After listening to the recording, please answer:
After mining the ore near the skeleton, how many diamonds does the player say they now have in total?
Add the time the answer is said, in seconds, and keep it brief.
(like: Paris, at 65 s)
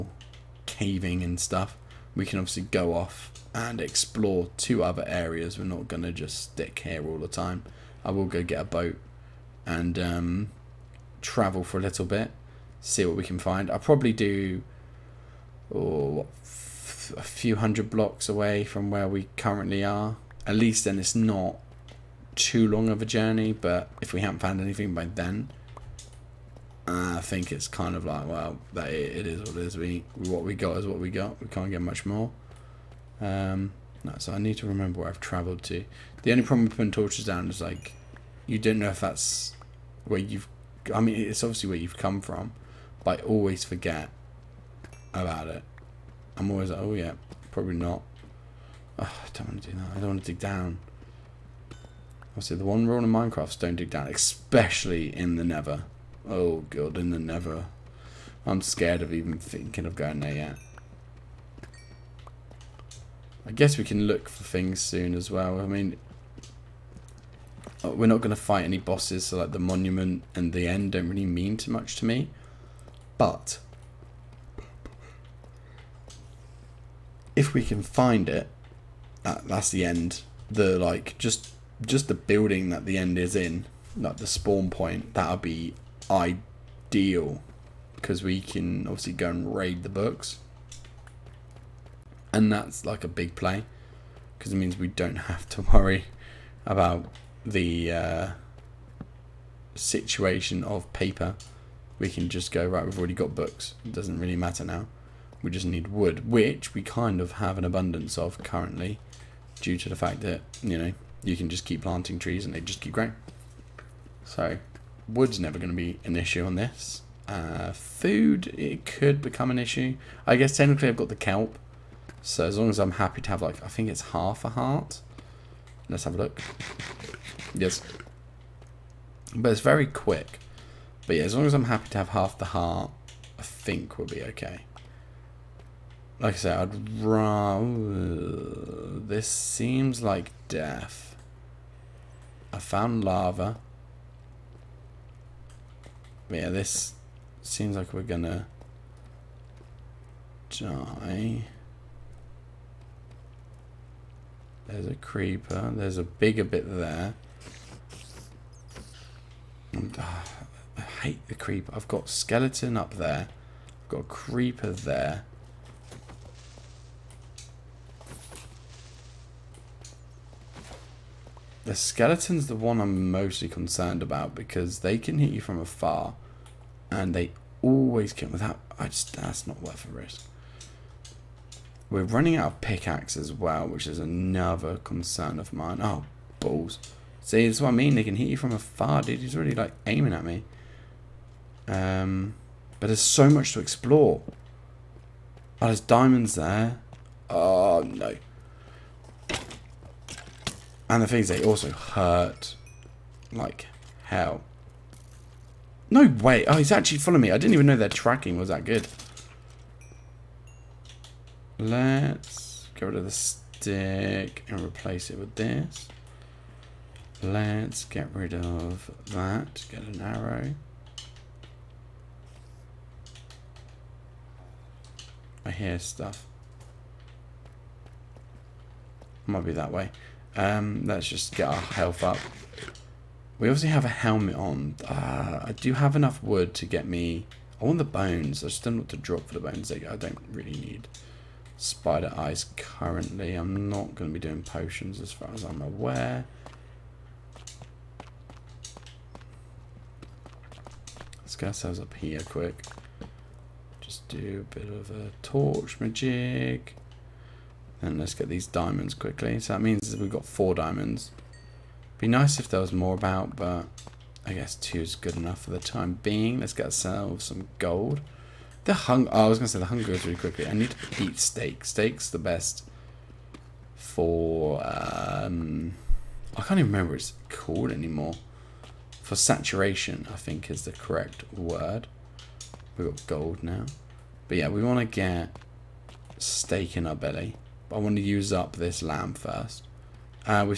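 4, at 260 s.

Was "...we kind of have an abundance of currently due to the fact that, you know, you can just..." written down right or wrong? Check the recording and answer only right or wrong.
right.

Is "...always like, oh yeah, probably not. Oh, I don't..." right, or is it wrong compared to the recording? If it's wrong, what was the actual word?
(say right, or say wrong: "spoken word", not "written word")
right.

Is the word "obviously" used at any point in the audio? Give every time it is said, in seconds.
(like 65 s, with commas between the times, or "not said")
2 s, 41 s, 52 s, 88 s, 233 s.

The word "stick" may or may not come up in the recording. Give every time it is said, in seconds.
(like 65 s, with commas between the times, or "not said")
6 s, 213 s.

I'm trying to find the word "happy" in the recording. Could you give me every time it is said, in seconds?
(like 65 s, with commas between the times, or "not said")
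122 s, 131 s.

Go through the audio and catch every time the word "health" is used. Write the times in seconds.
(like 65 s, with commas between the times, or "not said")
231 s.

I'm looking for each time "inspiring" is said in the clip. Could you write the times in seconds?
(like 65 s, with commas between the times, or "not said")
not said.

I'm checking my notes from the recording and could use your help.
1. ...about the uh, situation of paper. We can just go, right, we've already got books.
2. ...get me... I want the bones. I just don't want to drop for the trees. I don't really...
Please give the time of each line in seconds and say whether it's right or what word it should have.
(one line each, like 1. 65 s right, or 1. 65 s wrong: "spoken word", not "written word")
1. 96 s right
2. 236 s wrong: "bones", not "trees".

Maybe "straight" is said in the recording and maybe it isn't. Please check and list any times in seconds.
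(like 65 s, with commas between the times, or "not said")
not said.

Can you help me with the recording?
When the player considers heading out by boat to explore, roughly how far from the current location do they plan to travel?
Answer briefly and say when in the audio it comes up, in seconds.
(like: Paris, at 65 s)
A few hundred blocks, at 17 s.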